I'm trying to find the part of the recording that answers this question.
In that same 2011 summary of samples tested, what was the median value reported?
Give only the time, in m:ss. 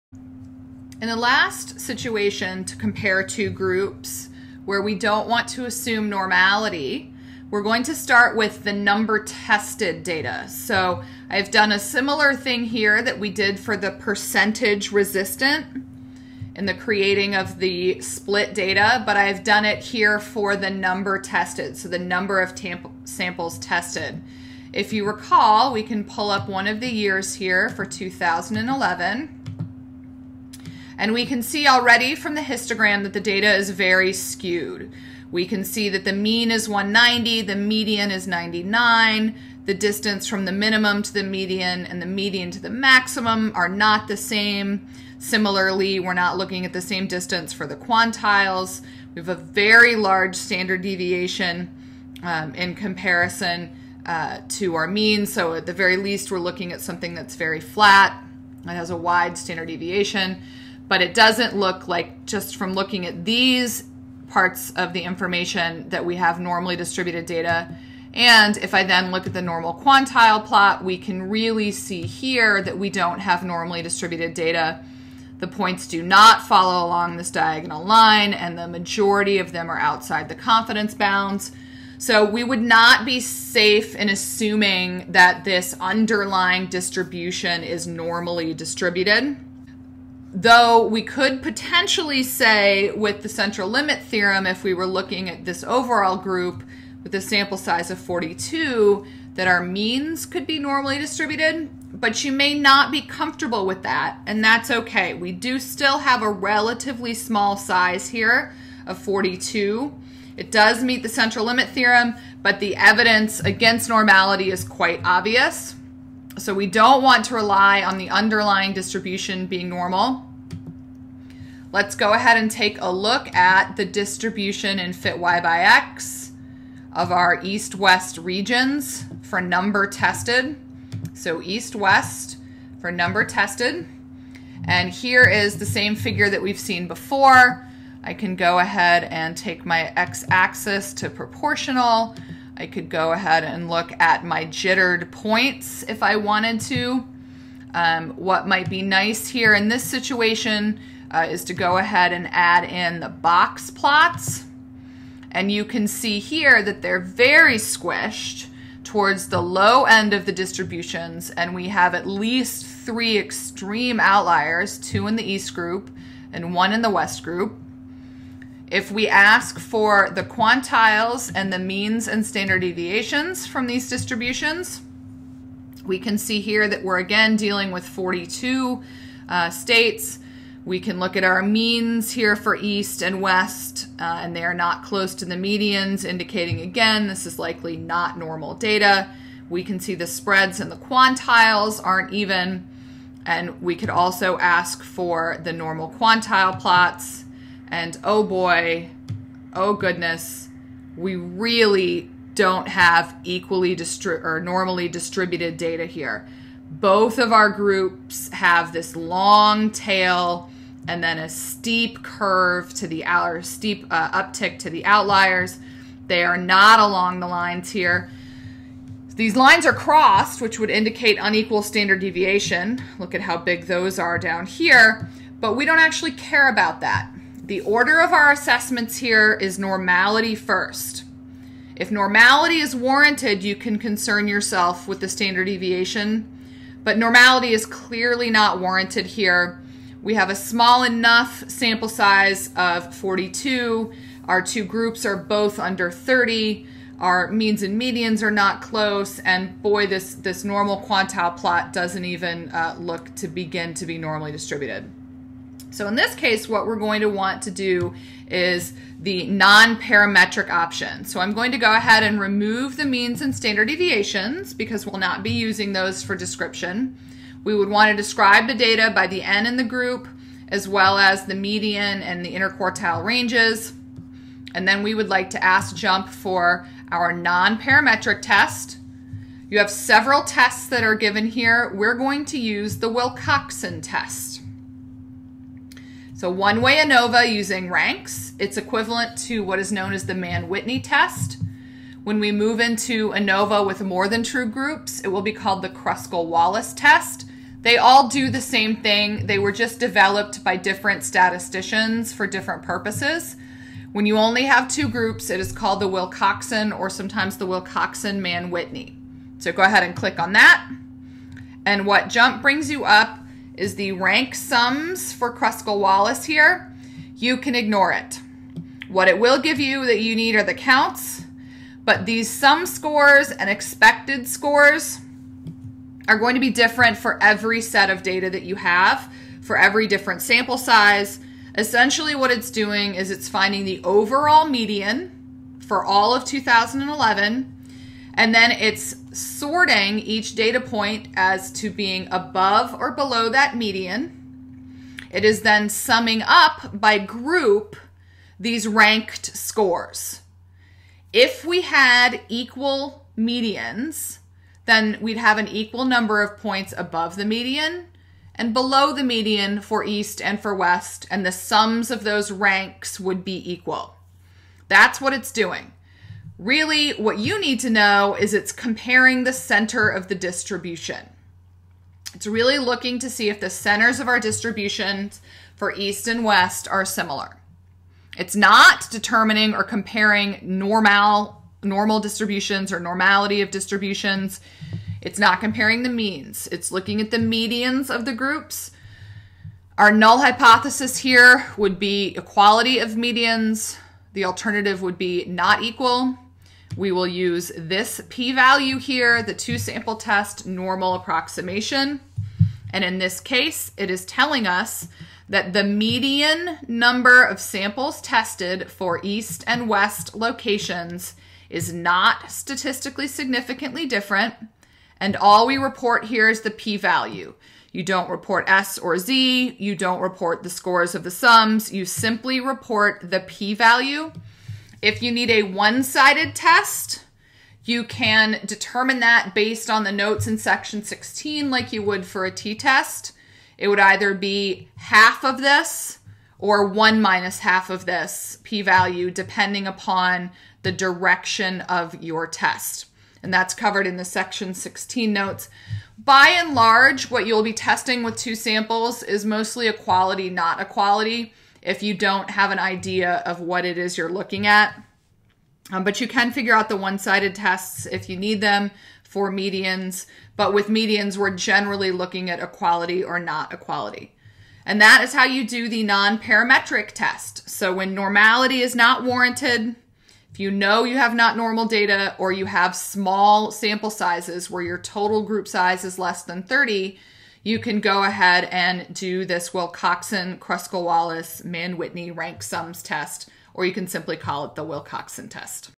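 0:38.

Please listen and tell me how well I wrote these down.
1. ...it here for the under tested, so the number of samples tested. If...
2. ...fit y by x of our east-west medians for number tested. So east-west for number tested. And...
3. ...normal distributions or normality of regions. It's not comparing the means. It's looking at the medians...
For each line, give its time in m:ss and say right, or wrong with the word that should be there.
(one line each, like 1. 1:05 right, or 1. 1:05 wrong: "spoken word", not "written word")
1. 0:19 wrong: "number", not "under"
2. 2:04 wrong: "regions", not "medians"
3. 6:21 wrong: "distributions", not "regions".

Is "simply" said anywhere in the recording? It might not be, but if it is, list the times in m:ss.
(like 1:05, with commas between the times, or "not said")
7:01, 8:03.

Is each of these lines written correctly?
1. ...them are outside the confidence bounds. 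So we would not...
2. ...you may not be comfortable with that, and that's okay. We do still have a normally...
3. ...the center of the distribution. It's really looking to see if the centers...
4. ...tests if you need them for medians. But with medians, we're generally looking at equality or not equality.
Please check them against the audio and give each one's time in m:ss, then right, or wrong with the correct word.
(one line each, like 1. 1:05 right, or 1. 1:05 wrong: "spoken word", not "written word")
1. 1:19 right
2. 1:42 wrong: "relatively", not "normally"
3. 6:09 right
4. 7:37 right.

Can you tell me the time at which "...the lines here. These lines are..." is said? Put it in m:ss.
3:37.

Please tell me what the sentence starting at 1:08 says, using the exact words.
And if I then look at the normal quantile plot, we can really see here that we don't have normally distributed data.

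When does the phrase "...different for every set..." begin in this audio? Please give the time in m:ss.
5:26.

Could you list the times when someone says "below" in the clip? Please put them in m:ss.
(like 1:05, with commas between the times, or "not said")
5:42, 5:58.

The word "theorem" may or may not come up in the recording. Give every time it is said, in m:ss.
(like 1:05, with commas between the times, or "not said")
1:34, 1:51.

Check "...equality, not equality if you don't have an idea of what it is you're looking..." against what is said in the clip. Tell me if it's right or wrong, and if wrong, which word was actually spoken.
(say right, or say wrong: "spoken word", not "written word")
right.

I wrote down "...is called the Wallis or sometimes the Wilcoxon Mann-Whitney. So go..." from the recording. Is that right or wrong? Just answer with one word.
wrong.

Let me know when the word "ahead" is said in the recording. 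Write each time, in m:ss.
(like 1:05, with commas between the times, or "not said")
2:02, 2:18, 2:23, 2:31, 4:21, 5:09, 7:58.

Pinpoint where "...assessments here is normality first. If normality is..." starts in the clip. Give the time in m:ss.
3:48.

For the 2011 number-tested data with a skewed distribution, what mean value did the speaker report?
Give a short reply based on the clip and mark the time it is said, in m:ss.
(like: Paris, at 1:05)
190, at 0:36.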